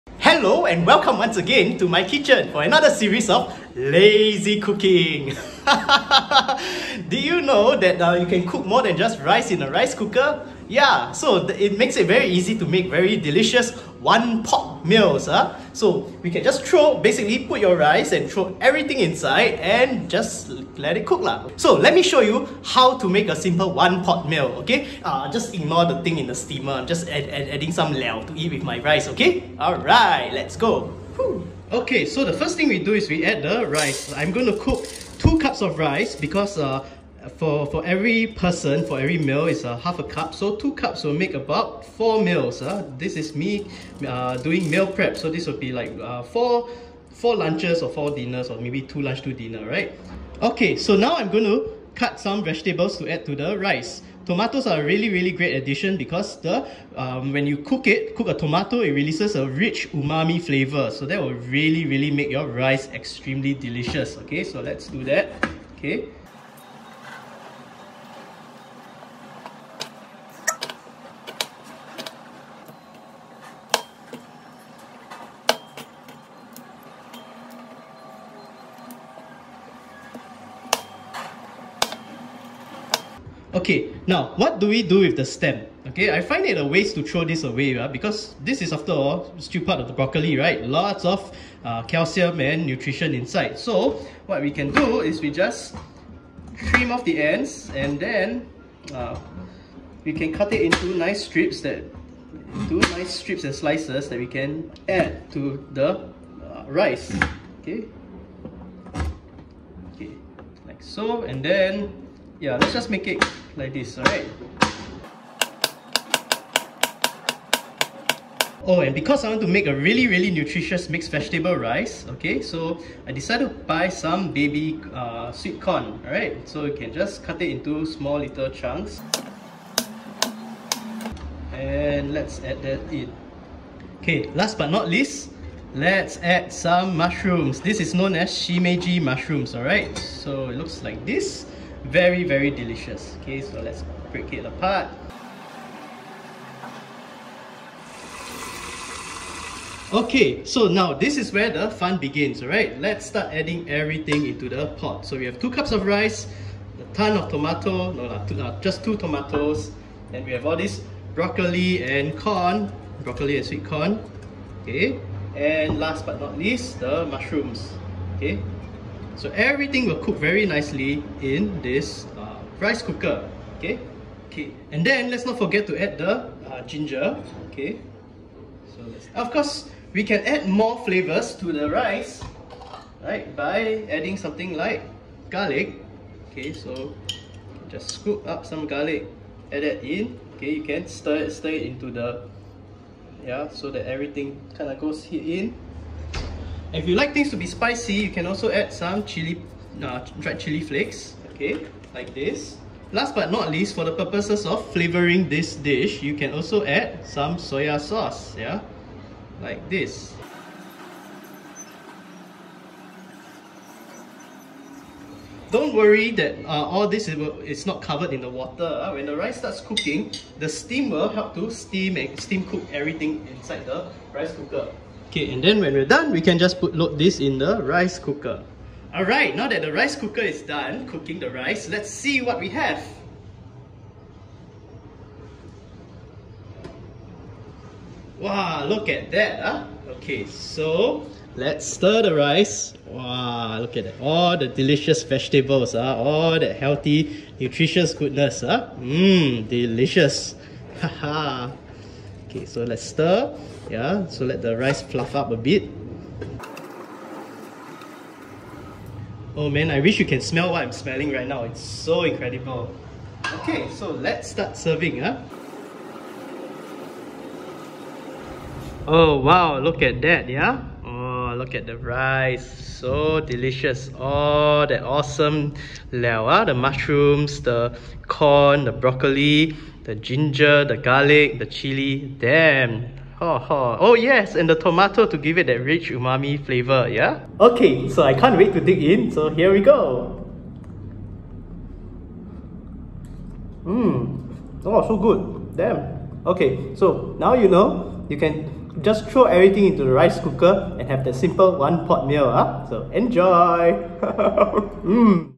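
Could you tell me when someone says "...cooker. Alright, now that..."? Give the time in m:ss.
3:47.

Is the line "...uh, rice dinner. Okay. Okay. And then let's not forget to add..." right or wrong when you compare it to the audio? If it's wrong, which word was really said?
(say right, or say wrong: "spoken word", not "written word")
wrong: "cooker", not "dinner".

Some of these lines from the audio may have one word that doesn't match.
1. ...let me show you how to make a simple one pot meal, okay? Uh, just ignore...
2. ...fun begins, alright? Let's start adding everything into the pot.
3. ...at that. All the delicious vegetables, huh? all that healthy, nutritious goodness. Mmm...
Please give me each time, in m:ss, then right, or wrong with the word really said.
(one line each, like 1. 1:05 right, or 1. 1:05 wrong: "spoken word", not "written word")
1. 0:21 right
2. 2:31 right
3. 4:03 right.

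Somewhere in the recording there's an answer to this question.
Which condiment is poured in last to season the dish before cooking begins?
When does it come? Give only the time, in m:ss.
3:27.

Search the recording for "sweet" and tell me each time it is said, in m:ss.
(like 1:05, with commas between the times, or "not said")
2:05, 2:43.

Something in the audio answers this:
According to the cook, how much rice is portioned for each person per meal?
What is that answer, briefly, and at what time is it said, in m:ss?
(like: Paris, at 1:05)
half a cup, at 0:39.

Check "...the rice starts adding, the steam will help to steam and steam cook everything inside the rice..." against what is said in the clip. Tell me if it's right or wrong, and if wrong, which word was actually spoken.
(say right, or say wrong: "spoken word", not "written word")
wrong: "cooking", not "adding".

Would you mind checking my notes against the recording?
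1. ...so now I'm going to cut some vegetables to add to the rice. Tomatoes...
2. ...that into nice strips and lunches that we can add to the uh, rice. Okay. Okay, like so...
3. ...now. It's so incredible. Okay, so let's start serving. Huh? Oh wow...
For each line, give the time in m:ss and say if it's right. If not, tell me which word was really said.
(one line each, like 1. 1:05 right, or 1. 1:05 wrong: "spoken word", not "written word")
1. 0:50 right
2. 1:41 wrong: "slices", not "lunches"
3. 4:21 right.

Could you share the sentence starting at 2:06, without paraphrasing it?
So you can just cut it into small little chunks.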